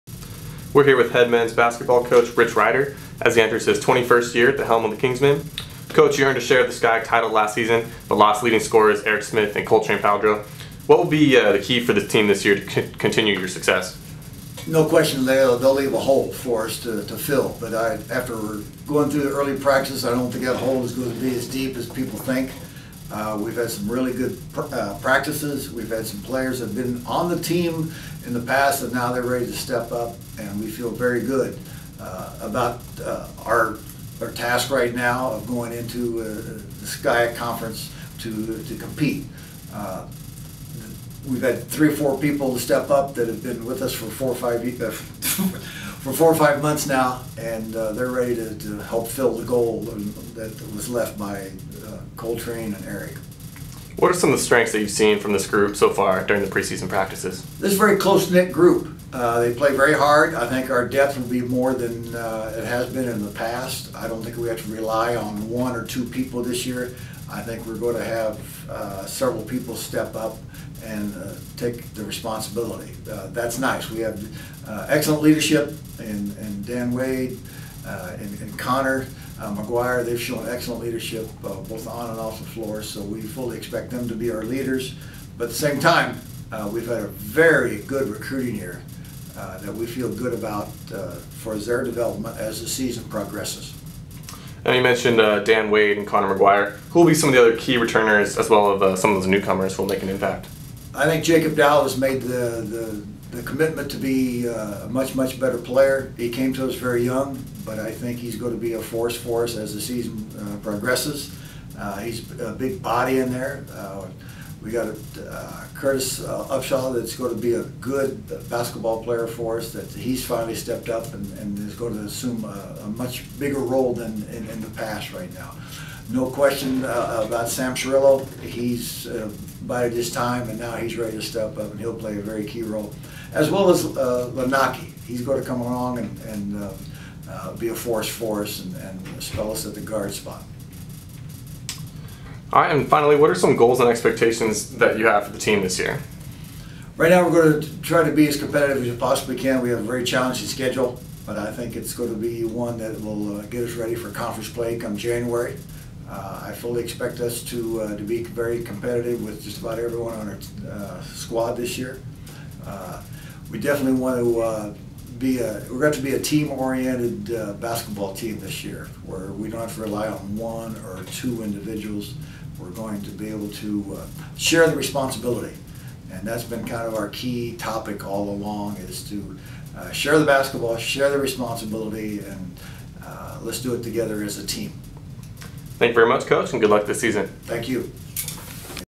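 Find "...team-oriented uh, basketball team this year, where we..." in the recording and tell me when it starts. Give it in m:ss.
2:46.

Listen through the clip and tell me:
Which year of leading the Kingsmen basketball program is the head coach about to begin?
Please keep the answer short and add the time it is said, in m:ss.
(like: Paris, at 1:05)
21st, at 0:03.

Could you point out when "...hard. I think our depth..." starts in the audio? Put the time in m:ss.
0:59.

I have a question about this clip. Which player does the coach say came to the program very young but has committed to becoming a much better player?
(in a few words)
Jacob Dowell.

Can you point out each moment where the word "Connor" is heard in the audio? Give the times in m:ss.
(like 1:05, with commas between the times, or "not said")
1:18, 1:36.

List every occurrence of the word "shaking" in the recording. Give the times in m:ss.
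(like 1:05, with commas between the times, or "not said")
not said.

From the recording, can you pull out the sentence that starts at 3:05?
Thank you very much, Coach, and good luck this season.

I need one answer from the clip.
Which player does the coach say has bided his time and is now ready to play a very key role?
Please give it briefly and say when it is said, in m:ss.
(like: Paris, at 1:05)
Sam Cirillo, at 2:07.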